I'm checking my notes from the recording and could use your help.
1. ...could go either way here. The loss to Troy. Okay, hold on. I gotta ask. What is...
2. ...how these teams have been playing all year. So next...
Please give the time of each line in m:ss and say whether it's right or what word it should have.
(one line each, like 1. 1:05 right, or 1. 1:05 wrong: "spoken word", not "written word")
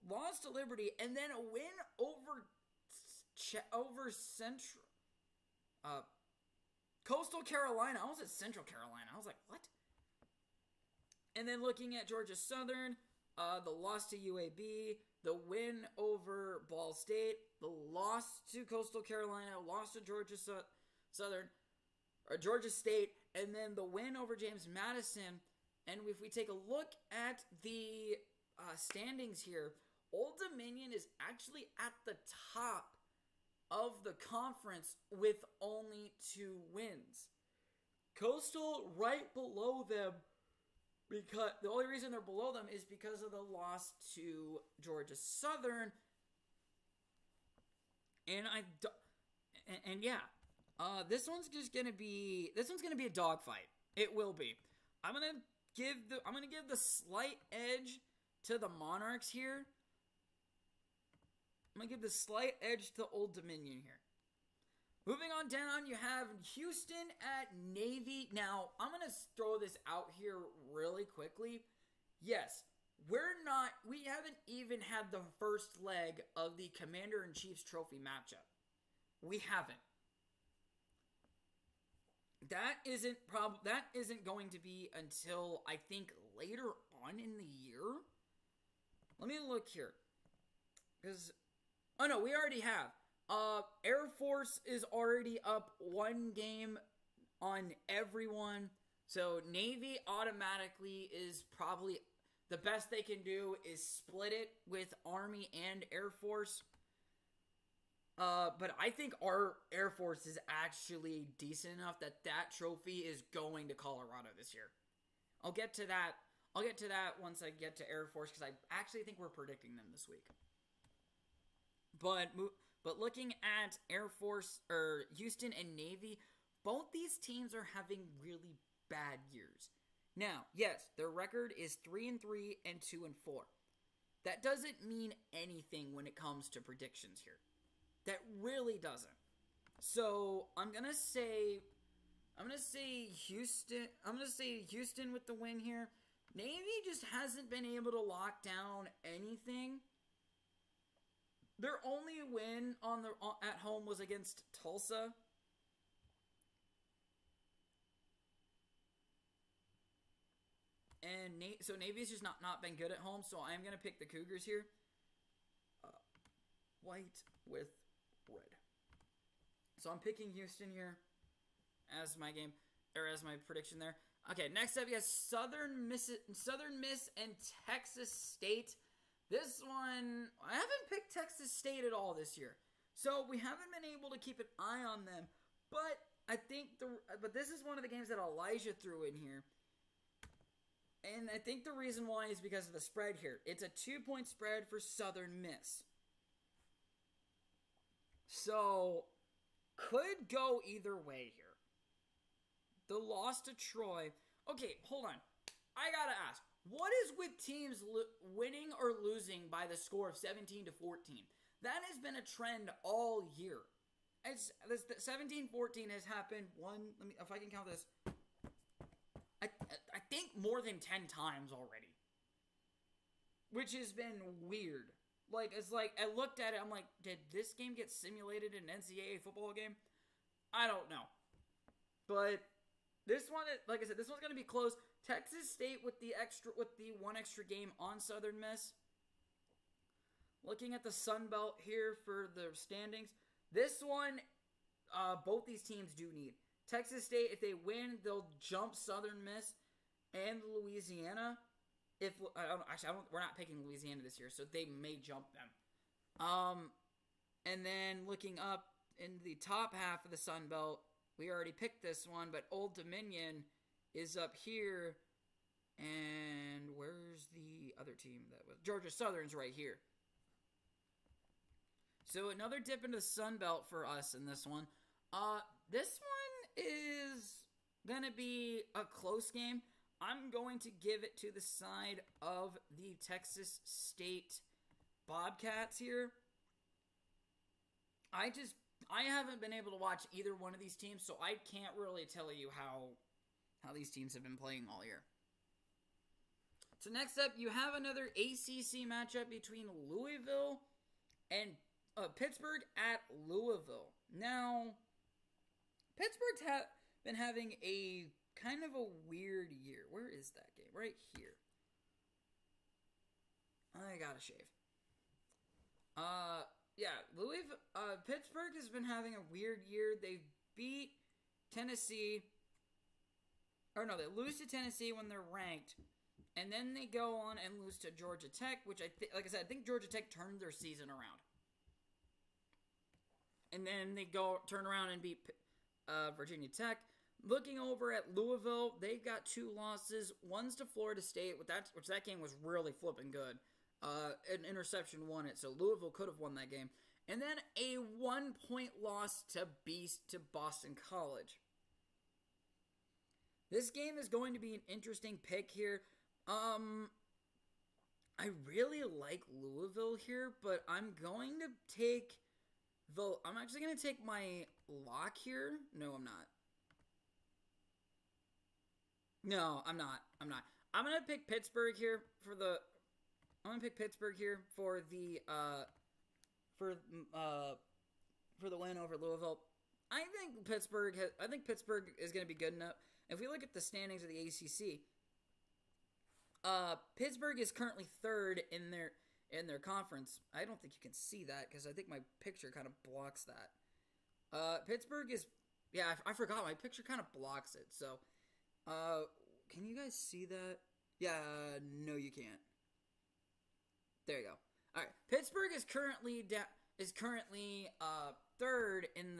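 1. 3:19 right
2. 4:53 right.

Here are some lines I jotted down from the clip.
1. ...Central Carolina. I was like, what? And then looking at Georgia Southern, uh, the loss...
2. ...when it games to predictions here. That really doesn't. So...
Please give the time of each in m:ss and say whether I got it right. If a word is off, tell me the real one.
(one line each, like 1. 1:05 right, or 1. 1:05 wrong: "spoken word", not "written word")
1. 0:08 right
2. 2:15 wrong: "comes", not "games".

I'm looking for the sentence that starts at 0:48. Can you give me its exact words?
And I and, and yeah, uh, this one's just gonna be this one's gonna be a dogfight.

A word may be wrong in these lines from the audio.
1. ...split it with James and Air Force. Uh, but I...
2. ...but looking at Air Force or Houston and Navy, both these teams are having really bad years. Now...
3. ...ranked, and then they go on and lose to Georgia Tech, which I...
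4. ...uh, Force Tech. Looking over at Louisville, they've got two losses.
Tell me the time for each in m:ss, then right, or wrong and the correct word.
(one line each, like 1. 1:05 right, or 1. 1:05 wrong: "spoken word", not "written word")
1. 1:43 wrong: "Army", not "James"
2. 2:02 right
3. 5:25 right
4. 5:35 wrong: "Virginia", not "Force".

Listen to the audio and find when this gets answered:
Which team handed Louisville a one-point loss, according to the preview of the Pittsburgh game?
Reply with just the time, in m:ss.
5:50.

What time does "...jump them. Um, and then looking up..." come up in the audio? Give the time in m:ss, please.
4:14.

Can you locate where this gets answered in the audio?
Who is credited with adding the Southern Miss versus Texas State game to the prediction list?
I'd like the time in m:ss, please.
3:08.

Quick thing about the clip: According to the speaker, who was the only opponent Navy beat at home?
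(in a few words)
Tulsa.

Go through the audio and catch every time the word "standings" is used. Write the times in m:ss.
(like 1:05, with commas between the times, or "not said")
0:28, 4:02, 6:23.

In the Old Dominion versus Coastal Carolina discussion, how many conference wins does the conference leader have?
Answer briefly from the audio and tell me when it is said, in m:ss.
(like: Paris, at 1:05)
2, at 0:36.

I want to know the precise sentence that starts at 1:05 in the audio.
Moving on down, you have Houston at Navy.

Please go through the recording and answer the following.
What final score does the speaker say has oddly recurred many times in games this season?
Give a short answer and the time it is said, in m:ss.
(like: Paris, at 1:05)
17-14, at 3:30.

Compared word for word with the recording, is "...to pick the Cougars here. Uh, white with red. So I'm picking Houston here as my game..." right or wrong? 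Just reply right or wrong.
right.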